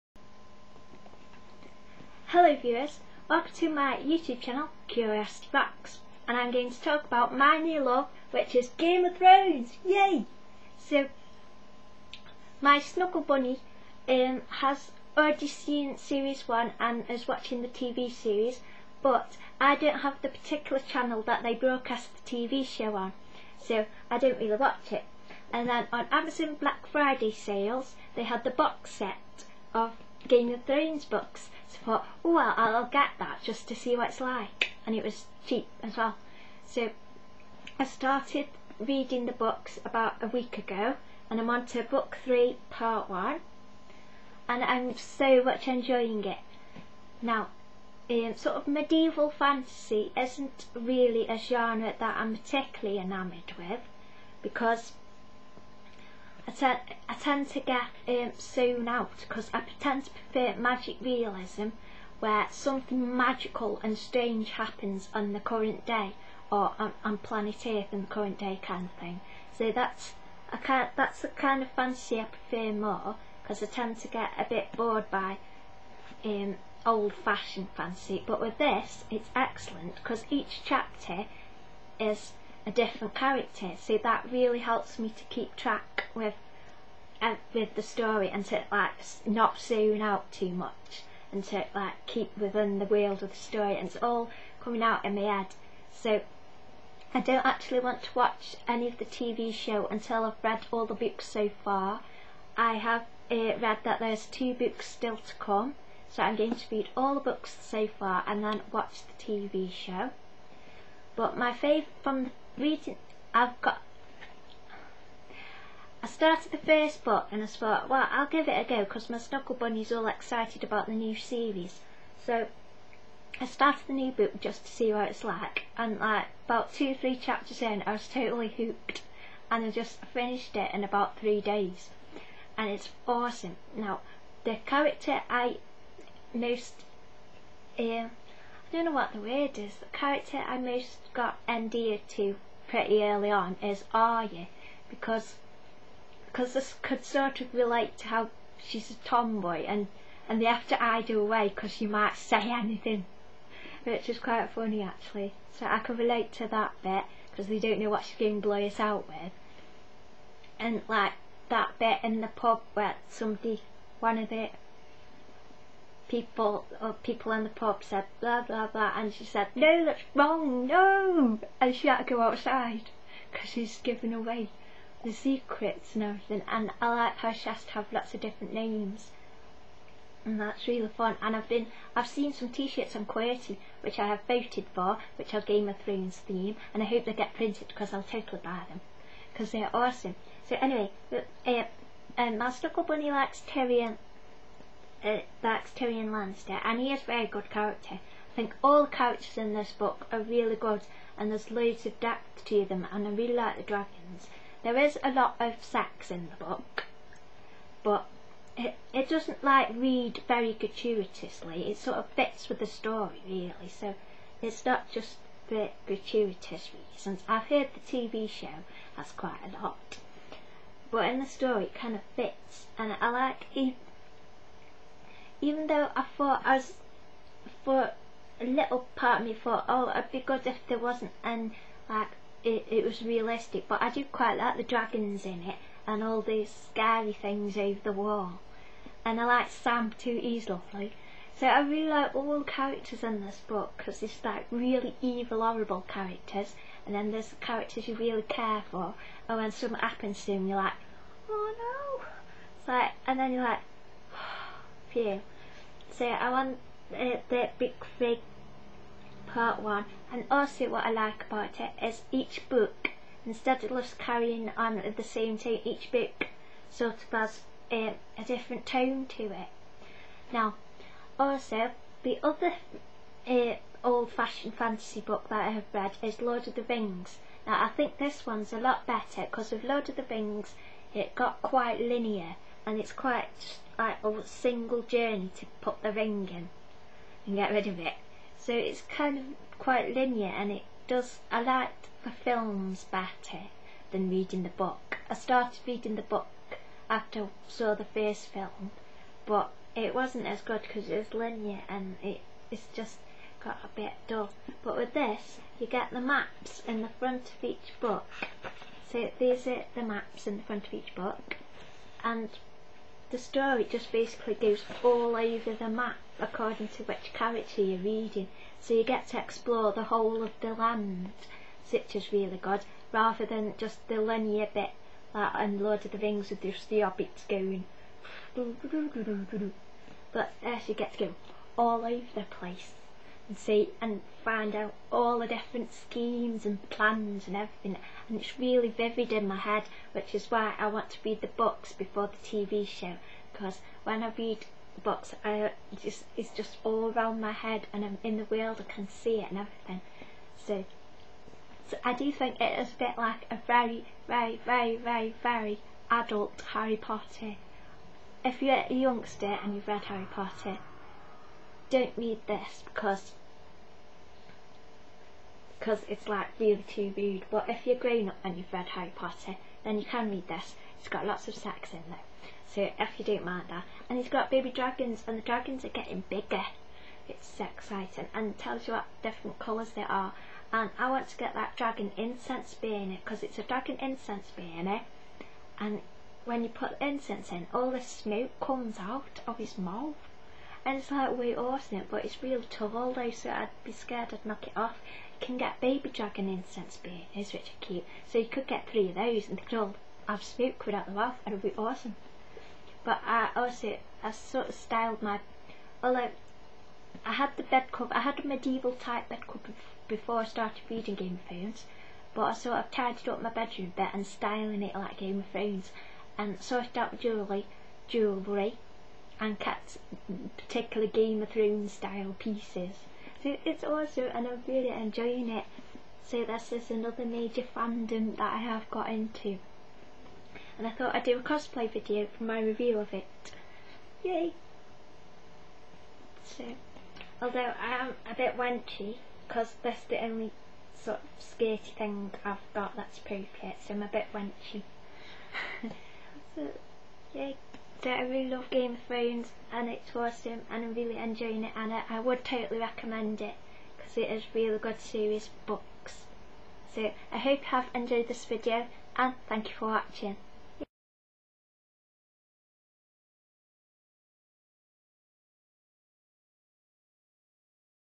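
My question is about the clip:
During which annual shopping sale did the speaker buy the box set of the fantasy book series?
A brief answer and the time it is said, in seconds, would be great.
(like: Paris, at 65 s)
Black Friday, at 26 s.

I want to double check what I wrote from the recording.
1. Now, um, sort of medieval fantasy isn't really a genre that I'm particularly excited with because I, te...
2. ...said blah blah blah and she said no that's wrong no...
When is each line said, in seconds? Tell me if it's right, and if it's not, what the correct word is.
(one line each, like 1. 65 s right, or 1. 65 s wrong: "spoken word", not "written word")
1. 47 s wrong: "enamoured", not "excited"
2. 167 s right.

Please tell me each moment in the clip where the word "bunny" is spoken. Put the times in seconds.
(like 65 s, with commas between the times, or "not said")
13 s, 119 s, 192 s.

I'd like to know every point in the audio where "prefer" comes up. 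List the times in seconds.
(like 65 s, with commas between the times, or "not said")
60 s, 72 s.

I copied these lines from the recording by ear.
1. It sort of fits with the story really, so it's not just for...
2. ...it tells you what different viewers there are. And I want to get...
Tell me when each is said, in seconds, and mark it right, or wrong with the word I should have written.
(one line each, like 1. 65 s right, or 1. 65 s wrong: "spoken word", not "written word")
1. 211 s right
2. 378 s wrong: "colours", not "viewers".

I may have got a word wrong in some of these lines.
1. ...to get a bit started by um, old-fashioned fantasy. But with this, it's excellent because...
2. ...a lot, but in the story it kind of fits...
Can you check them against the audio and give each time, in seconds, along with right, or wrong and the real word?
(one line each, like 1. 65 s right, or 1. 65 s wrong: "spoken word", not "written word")
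1. 74 s wrong: "bored", not "started"
2. 219 s right.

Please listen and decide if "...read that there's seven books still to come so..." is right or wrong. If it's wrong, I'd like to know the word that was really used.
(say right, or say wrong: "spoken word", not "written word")
wrong: "two", not "seven".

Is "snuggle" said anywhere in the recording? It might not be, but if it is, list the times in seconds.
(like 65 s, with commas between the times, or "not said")
12 s, 119 s, 192 s.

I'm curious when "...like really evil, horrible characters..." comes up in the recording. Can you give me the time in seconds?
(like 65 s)
244 s.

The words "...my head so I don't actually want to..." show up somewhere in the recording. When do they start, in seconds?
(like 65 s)
95 s.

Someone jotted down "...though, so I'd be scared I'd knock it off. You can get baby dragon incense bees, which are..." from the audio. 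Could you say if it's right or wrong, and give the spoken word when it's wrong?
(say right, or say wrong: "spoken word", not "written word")
right.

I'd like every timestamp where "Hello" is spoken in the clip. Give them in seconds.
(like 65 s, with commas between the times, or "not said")
2 s.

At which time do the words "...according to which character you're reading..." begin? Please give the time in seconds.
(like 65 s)
316 s.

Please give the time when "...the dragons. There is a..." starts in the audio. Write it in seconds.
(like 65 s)
203 s.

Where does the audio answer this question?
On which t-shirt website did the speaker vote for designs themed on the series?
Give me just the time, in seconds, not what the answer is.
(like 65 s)
183 s.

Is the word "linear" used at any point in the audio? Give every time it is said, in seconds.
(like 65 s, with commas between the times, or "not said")
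281 s, 289 s, 301 s, 323 s.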